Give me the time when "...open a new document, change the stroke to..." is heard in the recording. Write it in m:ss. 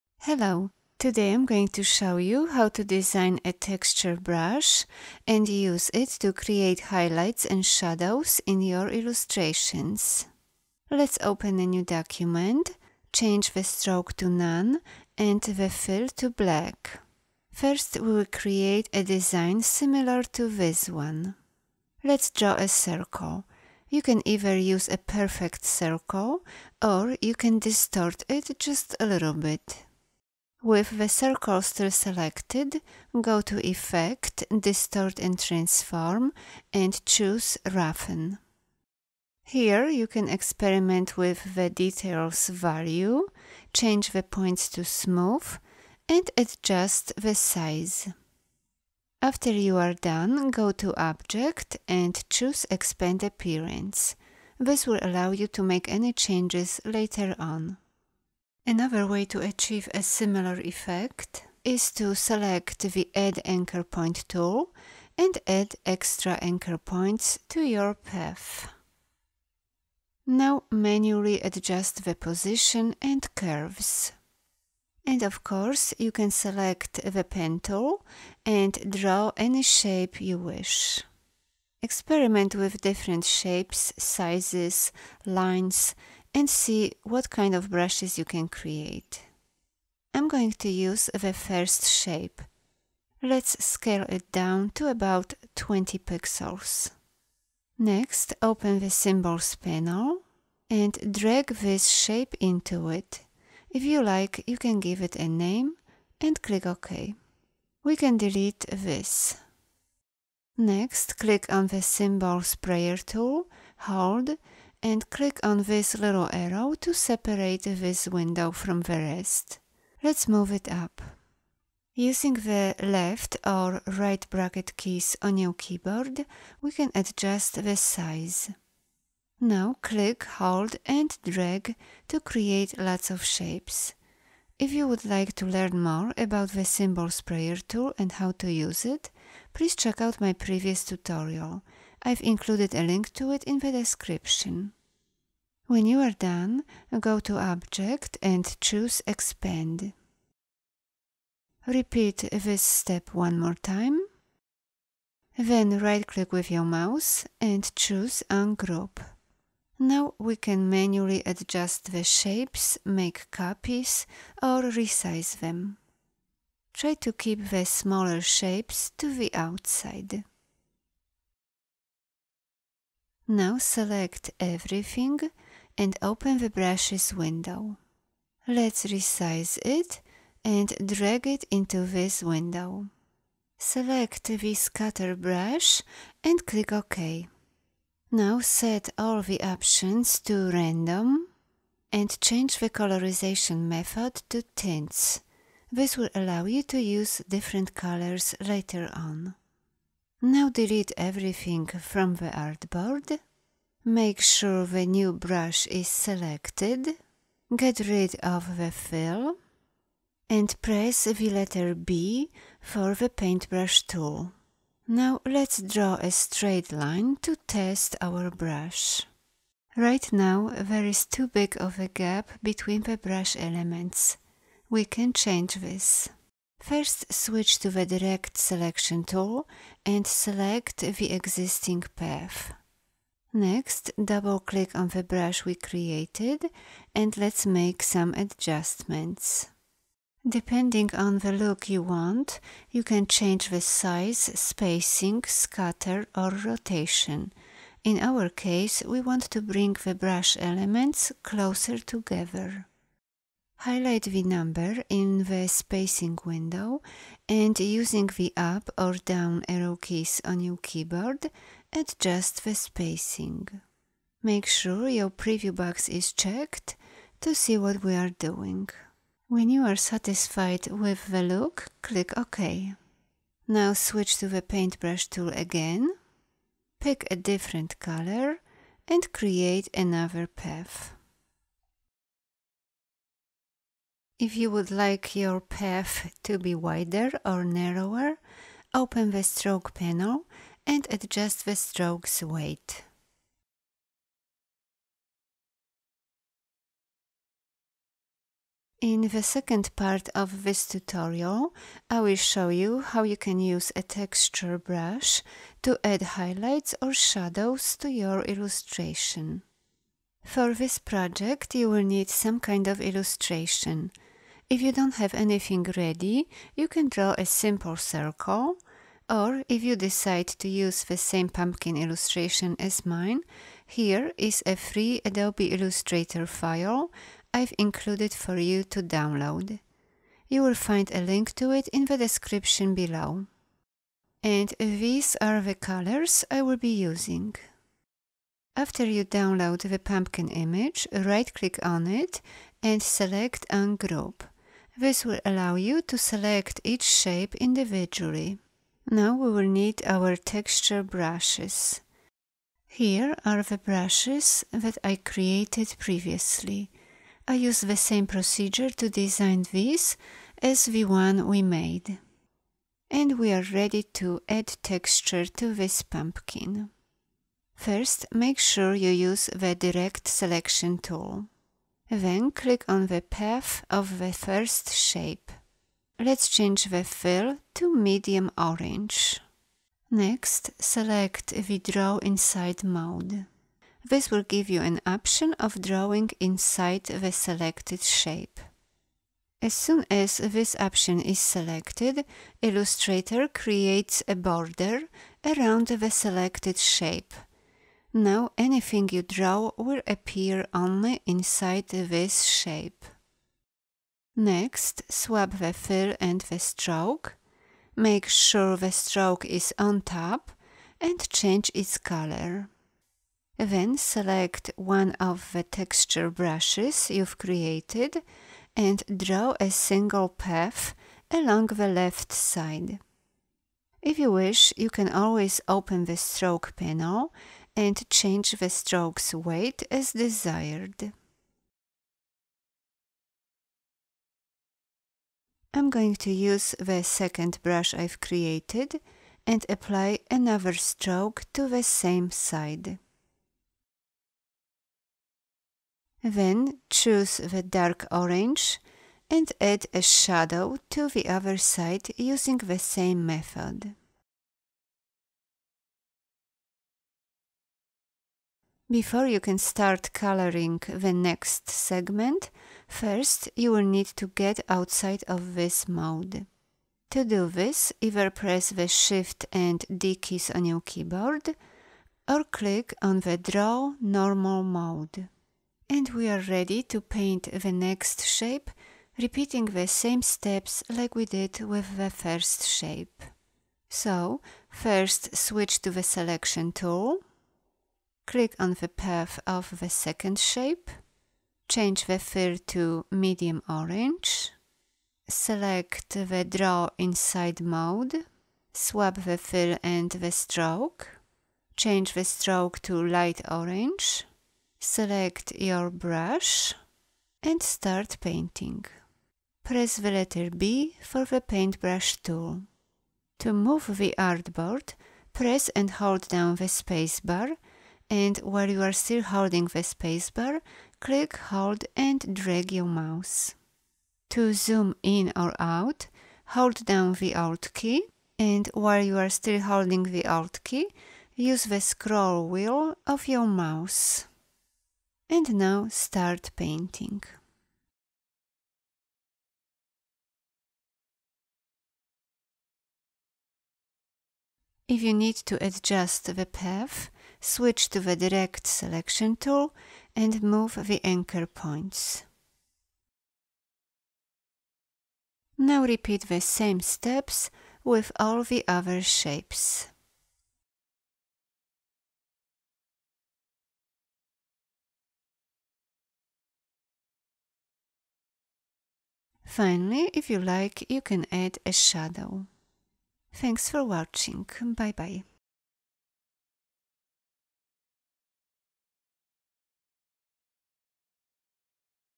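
0:11.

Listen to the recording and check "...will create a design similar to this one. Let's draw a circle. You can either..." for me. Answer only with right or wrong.
right.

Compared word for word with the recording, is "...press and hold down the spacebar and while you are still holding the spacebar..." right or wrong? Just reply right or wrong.
right.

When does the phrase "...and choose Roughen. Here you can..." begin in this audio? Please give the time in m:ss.
0:36.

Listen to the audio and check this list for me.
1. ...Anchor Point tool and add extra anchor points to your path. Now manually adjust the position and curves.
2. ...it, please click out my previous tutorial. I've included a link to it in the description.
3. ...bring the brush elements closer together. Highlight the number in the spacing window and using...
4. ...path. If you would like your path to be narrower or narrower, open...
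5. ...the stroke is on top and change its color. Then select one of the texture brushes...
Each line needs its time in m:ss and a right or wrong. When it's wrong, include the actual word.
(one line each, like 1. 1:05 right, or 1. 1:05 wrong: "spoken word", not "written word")
1. 1:03 right
2. 2:18 wrong: "check", not "click"
3. 4:09 right
4. 4:40 wrong: "wider", not "narrower"
5. 6:48 right.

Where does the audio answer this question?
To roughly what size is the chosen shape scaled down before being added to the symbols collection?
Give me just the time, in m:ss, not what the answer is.
1:35.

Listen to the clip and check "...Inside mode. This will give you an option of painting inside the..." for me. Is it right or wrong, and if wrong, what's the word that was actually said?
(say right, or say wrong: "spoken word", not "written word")
wrong: "drawing", not "painting".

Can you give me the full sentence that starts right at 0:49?
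After you are done, go to Object and choose Expand Appearance.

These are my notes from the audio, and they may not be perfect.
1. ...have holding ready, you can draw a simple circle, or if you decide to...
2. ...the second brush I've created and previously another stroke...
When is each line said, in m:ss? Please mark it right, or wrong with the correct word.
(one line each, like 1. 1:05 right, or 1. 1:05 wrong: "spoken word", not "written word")
1. 5:14 wrong: "anything", not "holding"
2. 7:16 wrong: "apply", not "previously".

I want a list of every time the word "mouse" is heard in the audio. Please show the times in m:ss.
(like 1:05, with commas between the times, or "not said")
2:36, 8:42, 8:53.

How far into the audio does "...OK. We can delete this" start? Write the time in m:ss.
1:46.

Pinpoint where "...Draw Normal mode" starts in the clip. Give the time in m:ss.
7:53.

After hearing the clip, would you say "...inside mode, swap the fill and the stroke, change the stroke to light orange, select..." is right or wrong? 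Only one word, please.
right.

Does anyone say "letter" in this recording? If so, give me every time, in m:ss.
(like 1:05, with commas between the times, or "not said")
3:31, 8:29.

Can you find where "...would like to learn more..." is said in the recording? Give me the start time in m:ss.
2:14.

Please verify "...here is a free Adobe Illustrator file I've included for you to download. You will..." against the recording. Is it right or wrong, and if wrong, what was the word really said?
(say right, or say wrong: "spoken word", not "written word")
right.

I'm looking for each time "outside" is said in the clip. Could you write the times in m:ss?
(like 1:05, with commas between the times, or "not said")
2:49, 7:44.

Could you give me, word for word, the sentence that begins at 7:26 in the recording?
Then choose the dark orange and add a shadow to the other side using the same method.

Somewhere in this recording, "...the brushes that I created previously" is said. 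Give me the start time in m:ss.
5:53.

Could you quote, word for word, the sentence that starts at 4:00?
Depending on the look you want, you can change the size, spacing, scatter or rotation.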